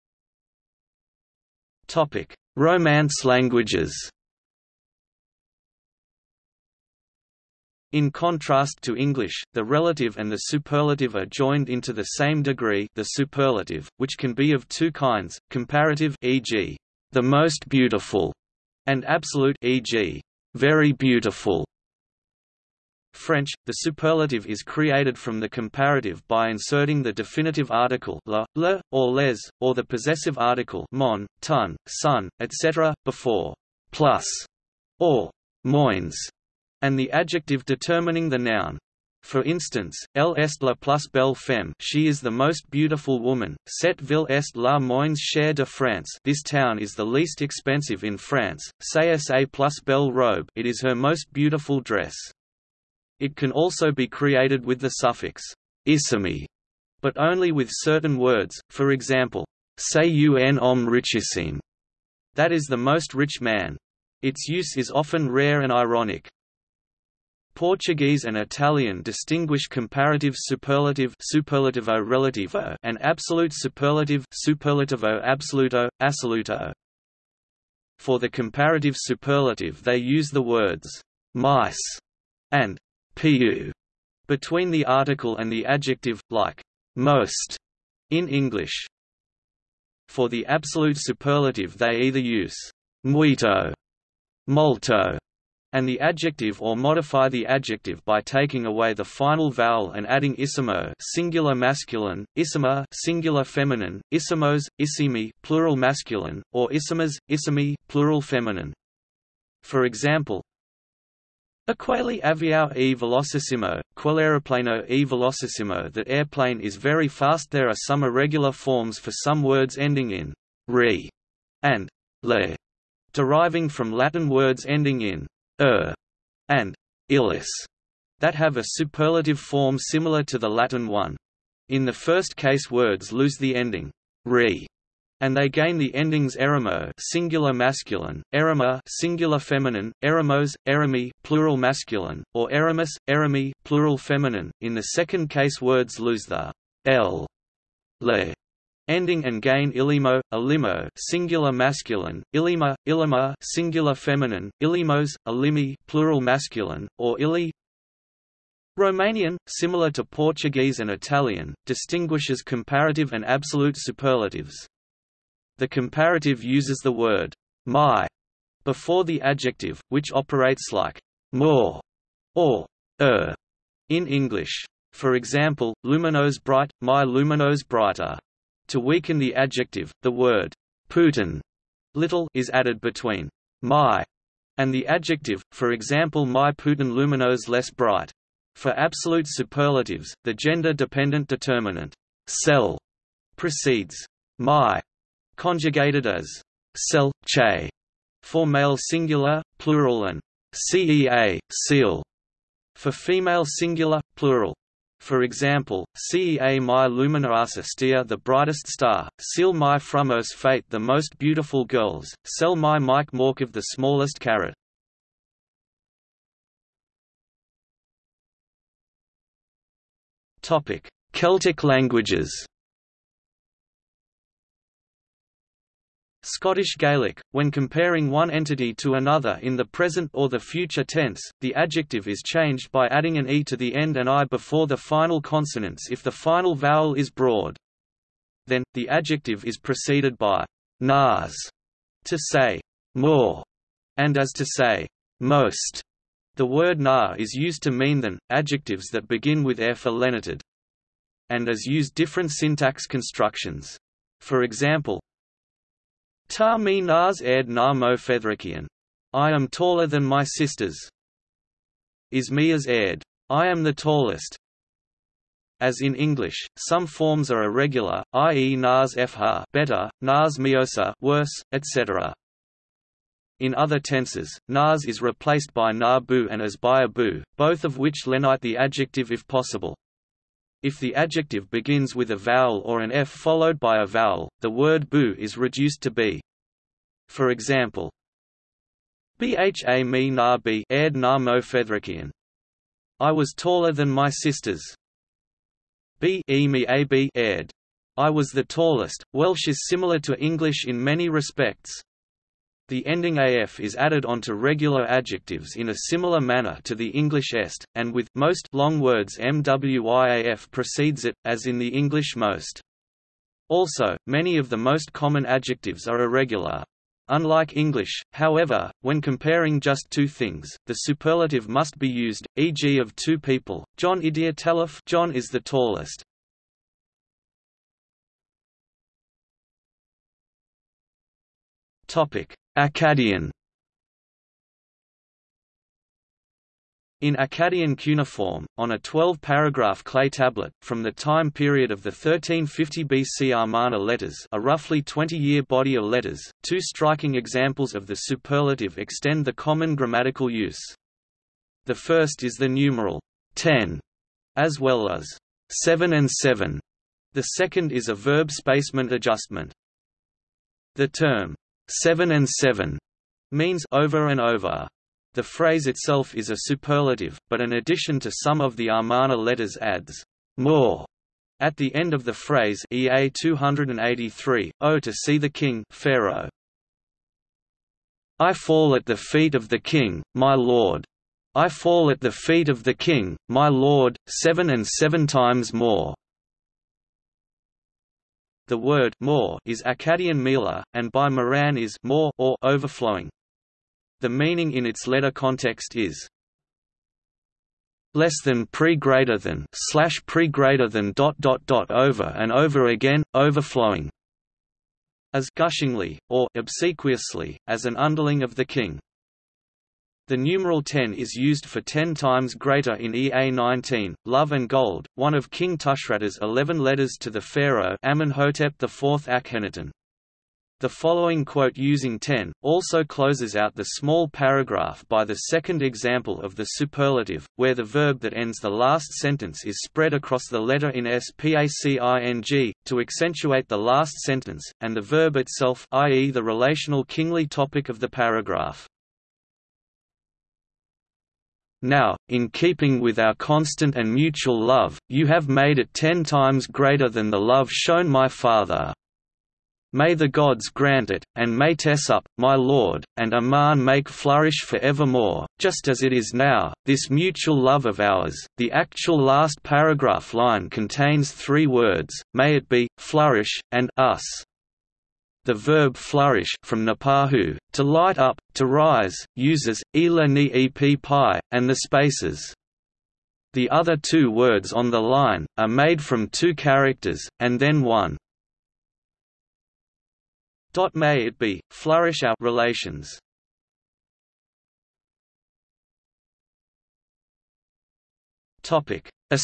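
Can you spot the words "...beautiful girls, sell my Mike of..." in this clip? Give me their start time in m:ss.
3:31.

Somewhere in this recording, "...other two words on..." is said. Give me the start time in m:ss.
7:53.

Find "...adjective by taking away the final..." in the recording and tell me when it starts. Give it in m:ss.
1:37.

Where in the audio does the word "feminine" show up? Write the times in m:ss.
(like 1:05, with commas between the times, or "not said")
1:43, 1:48, 2:19, 2:23, 2:33.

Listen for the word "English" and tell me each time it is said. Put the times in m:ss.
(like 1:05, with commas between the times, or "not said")
0:08, 1:28, 2:54, 4:25, 5:00, 5:06, 5:11, 5:17.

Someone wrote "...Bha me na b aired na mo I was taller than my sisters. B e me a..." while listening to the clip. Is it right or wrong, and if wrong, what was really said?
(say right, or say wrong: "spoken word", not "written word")
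right.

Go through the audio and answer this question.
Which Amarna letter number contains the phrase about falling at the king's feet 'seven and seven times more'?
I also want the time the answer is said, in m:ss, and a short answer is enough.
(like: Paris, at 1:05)
EA 283, at 6:12.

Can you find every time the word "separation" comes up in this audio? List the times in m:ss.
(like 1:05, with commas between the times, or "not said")
not said.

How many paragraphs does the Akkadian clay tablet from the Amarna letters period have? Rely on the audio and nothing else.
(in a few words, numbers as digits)
12.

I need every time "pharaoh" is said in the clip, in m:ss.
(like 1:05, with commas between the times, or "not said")
6:15, 6:57.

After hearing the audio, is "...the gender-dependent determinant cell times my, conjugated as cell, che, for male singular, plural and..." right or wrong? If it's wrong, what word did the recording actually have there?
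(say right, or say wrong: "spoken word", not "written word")
wrong: "precedes", not "times".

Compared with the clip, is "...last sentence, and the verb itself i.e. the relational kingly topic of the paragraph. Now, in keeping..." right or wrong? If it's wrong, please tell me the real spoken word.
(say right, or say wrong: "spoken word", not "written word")
right.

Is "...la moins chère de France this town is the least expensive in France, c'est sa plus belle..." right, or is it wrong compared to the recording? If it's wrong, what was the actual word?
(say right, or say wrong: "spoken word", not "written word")
right.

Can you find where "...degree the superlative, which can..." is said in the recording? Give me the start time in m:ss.
0:12.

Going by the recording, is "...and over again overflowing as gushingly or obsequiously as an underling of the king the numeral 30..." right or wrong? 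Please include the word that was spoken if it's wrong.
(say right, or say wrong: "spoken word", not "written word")
wrong: "10", not "30".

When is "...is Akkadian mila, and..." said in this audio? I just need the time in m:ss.
6:29.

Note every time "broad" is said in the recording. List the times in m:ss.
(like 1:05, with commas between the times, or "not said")
3:57.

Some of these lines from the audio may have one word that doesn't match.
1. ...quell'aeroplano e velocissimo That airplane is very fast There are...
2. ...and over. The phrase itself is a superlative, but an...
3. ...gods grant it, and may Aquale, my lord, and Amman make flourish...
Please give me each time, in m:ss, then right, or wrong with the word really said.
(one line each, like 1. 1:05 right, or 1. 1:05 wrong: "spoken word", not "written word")
1. 1:53 right
2. 6:04 right
3. 7:30 wrong: "Tessup", not "Aquale".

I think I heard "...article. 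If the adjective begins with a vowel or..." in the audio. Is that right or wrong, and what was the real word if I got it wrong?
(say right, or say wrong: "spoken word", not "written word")
wrong: "possible", not "article".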